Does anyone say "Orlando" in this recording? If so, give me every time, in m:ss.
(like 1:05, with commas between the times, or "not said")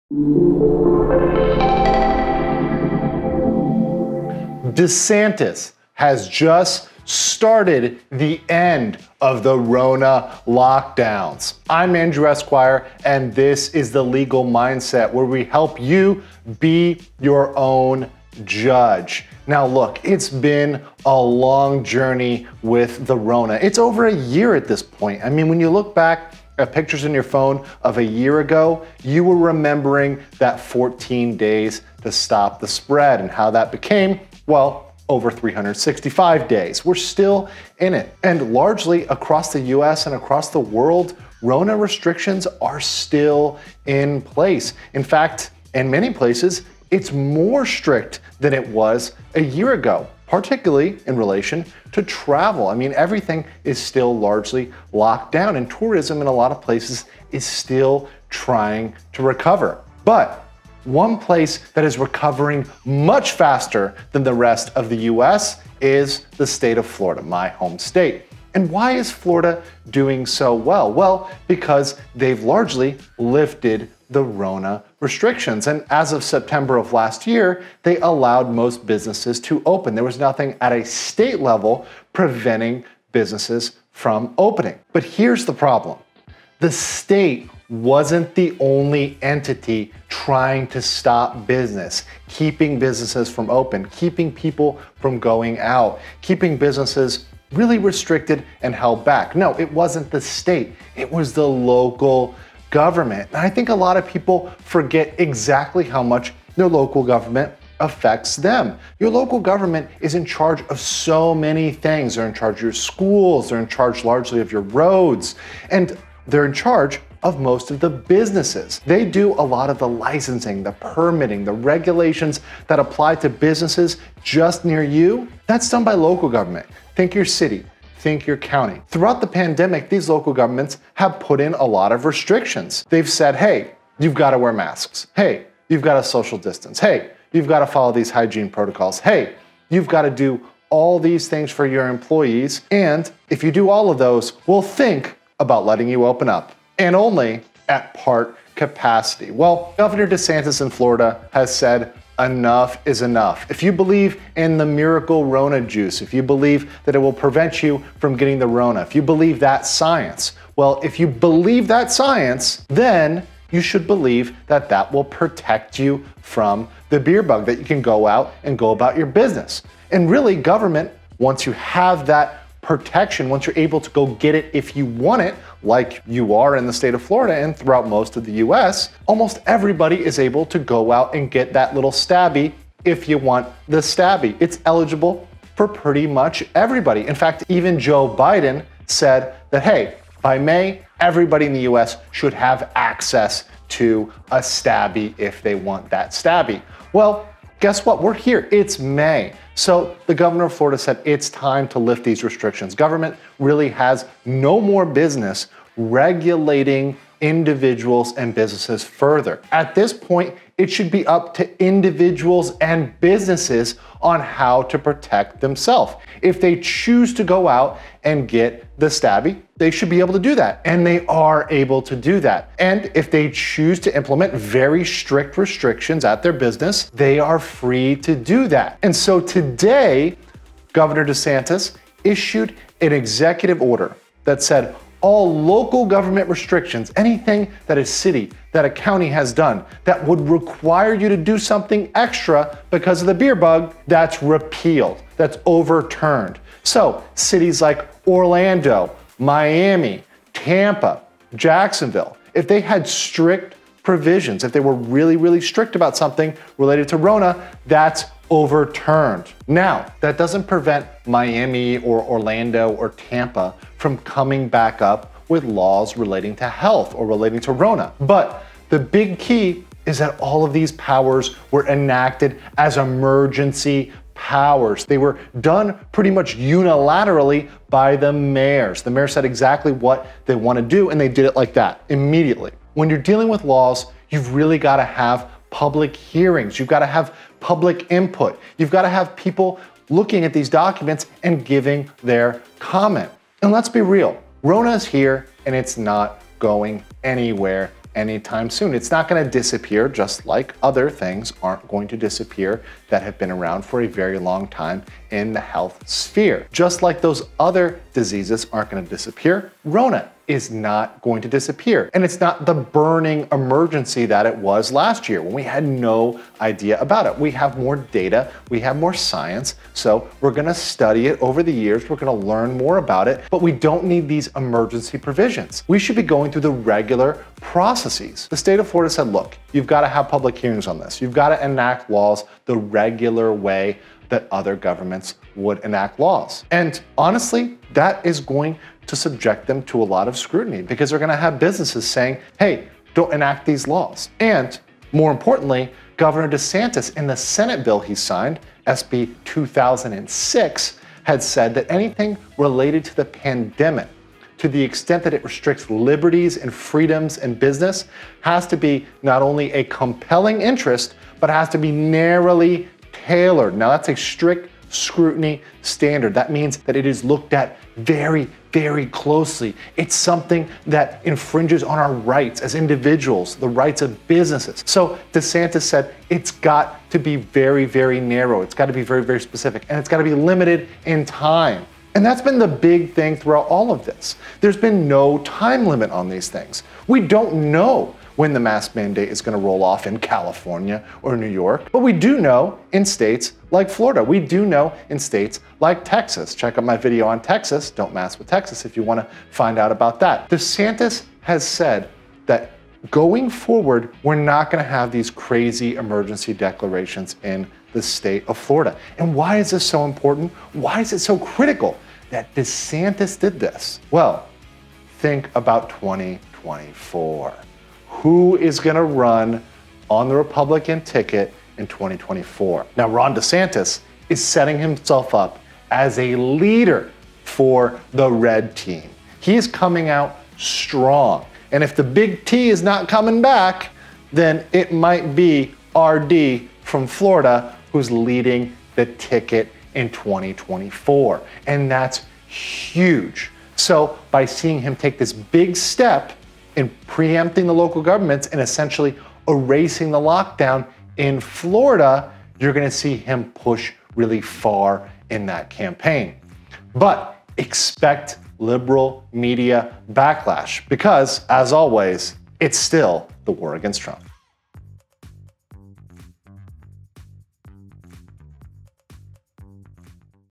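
4:08, 4:22.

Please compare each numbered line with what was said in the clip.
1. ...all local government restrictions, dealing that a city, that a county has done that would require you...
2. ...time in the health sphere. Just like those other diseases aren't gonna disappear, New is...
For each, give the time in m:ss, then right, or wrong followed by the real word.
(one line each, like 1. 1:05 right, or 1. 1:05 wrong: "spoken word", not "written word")
1. 3:55 wrong: "anything", not "dealing"
2. 5:04 wrong: "Rona", not "New".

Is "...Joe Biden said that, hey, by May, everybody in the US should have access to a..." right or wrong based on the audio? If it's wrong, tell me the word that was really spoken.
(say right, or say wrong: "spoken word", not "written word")
right.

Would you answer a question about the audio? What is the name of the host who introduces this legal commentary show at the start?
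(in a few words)
Andrew Esquire.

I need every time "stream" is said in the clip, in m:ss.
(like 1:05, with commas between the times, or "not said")
not said.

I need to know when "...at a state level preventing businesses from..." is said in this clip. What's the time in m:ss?
1:20.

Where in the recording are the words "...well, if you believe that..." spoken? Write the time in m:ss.
2:40.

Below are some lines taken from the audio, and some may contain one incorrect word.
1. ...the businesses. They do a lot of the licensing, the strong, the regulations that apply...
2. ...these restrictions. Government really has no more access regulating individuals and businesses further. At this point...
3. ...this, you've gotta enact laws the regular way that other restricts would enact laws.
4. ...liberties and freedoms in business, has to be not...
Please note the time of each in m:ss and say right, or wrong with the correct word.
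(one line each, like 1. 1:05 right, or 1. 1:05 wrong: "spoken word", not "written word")
1. 1:57 wrong: "permitting", not "strong"
2. 3:22 wrong: "business", not "access"
3. 5:30 wrong: "governments", not "restricts"
4. 5:55 right.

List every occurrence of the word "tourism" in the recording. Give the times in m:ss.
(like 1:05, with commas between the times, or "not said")
0:55.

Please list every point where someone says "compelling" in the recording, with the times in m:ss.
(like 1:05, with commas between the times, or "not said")
5:59.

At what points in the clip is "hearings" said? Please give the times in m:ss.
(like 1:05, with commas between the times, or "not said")
4:45, 5:30.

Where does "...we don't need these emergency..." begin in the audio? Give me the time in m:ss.
5:23.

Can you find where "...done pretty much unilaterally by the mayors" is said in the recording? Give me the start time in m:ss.
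4:35.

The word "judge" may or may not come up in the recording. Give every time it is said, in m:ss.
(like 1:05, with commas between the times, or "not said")
0:18.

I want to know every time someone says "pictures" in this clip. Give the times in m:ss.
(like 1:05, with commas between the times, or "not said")
0:26.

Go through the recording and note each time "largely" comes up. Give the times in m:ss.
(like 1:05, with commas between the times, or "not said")
0:38, 0:54, 1:12, 1:54.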